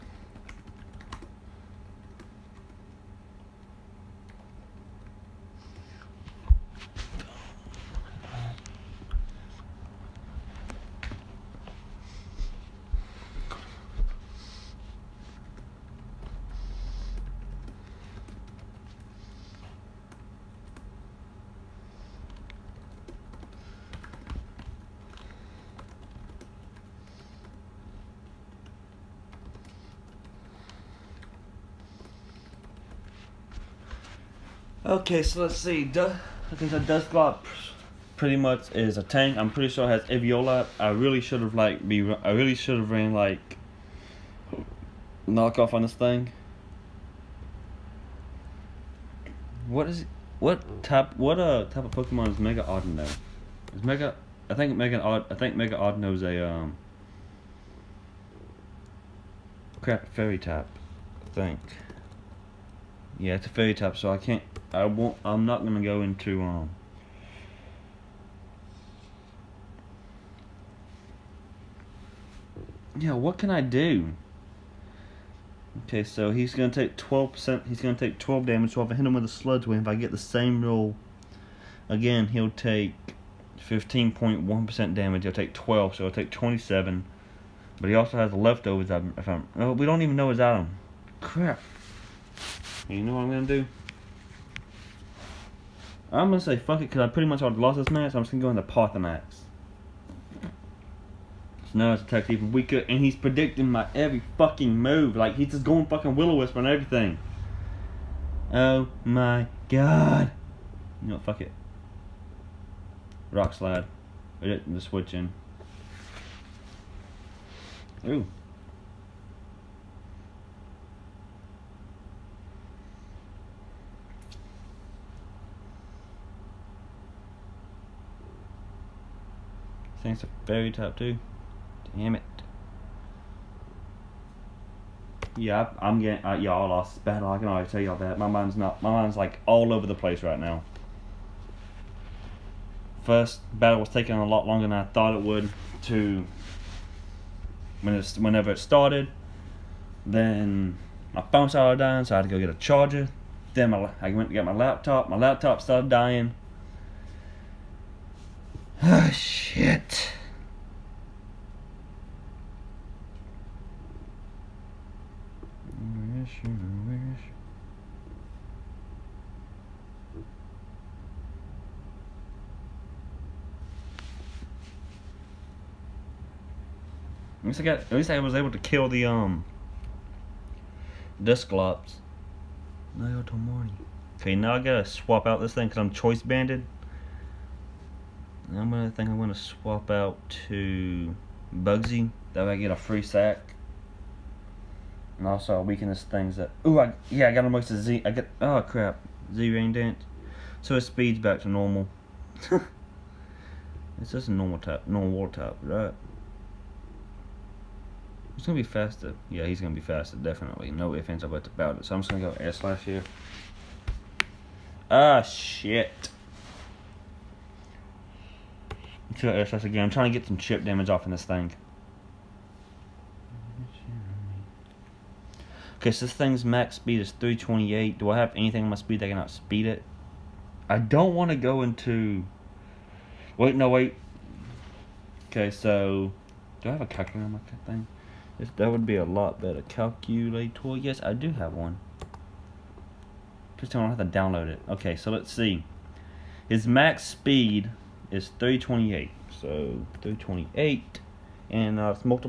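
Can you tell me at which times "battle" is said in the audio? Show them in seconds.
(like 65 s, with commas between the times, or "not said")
137 s, 143 s.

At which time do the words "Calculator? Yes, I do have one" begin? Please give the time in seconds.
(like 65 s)
239 s.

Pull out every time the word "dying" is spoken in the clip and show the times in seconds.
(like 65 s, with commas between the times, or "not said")
151 s, 155 s.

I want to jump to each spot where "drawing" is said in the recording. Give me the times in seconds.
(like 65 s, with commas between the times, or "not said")
not said.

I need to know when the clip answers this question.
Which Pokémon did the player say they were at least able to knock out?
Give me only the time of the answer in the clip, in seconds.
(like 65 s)
181 s.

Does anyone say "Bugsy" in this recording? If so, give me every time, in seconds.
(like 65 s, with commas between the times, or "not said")
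191 s.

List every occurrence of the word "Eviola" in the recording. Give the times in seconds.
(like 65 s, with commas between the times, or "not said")
40 s.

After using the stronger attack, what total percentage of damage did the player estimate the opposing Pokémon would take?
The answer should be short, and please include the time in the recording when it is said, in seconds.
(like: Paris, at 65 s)
27, at 86 s.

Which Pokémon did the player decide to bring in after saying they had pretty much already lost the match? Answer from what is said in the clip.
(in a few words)
Parthenax.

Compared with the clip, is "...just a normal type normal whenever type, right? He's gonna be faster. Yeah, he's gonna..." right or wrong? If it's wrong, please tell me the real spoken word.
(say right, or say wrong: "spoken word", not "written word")
wrong: "water", not "whenever".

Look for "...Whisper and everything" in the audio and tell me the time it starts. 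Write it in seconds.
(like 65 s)
106 s.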